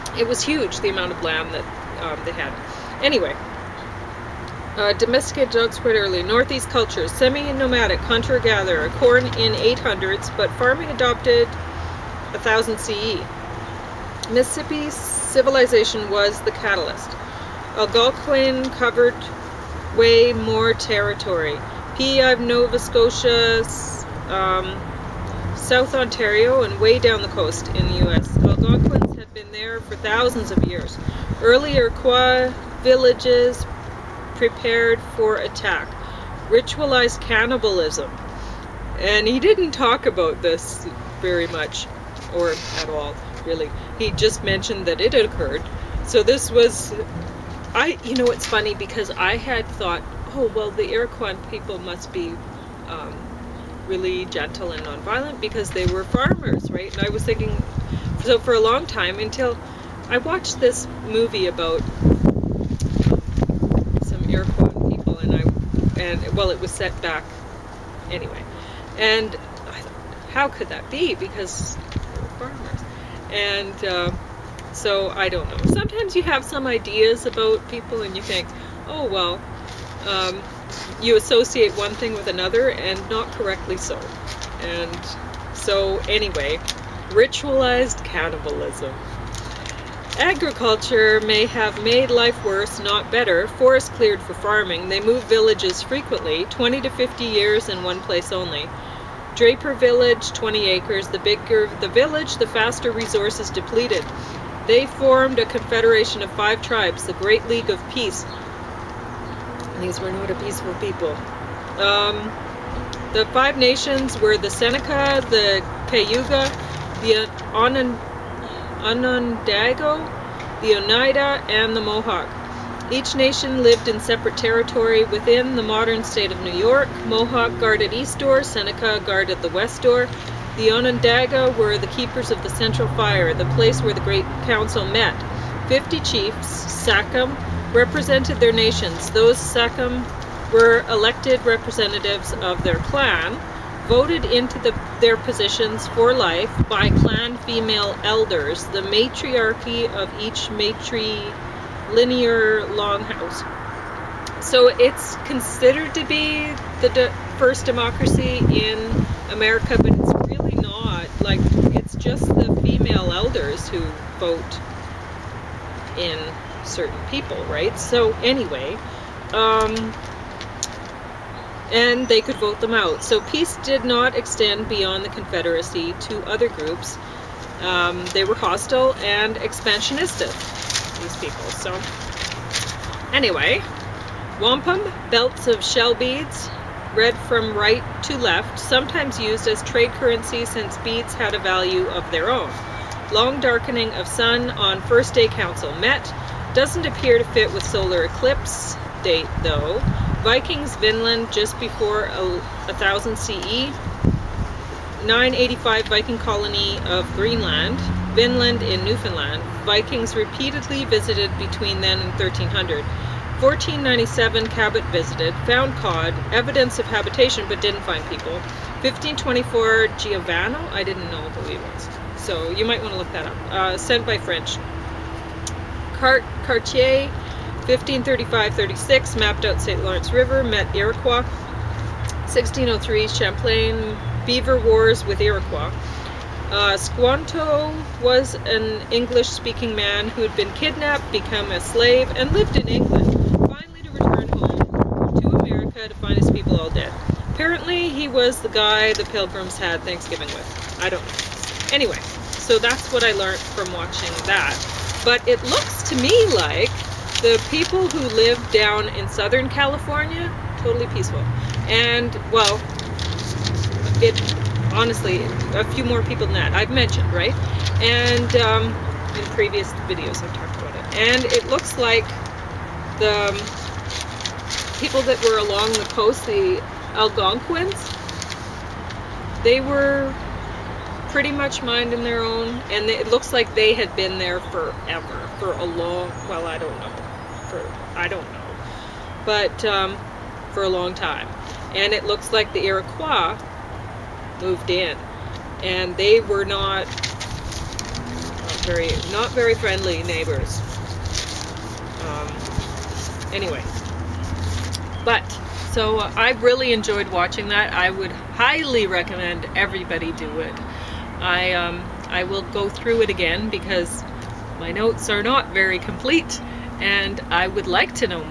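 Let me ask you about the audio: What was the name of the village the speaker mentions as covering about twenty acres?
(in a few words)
Draper Village.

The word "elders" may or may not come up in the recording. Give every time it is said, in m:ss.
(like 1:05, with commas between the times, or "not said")
2:28, 2:43.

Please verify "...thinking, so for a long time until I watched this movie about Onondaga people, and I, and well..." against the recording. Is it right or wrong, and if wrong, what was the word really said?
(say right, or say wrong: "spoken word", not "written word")
wrong: "Iroquois", not "Onondaga".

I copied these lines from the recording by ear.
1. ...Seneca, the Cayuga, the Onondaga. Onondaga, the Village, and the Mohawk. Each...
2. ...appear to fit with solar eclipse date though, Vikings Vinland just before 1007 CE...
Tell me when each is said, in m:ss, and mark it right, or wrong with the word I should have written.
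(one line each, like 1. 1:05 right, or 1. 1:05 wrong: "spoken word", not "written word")
1. 1:54 wrong: "Oneida", not "Village"
2. 3:16 wrong: "1000", not "1007".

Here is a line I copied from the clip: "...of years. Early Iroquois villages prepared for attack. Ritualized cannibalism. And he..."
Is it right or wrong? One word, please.
right.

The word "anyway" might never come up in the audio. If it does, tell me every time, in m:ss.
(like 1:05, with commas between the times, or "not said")
0:03, 1:08, 1:26, 2:48, 3:03, 4:11, 5:03.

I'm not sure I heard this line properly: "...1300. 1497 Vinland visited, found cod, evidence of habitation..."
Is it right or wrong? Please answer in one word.
wrong.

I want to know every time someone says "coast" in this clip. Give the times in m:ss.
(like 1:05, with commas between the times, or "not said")
0:27, 4:35.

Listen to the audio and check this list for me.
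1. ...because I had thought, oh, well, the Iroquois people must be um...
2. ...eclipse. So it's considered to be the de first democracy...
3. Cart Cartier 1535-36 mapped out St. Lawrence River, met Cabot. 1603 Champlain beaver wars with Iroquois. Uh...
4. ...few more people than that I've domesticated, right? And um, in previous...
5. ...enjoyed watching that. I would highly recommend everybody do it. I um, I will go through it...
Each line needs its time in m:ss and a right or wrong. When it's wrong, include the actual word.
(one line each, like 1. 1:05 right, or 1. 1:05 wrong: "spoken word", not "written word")
1. 0:48 right
2. 2:32 wrong: "longhouse", not "eclipse"
3. 3:45 wrong: "Iroquois", not "Cabot"
4. 4:25 wrong: "mentioned", not "domesticated"
5. 5:06 right.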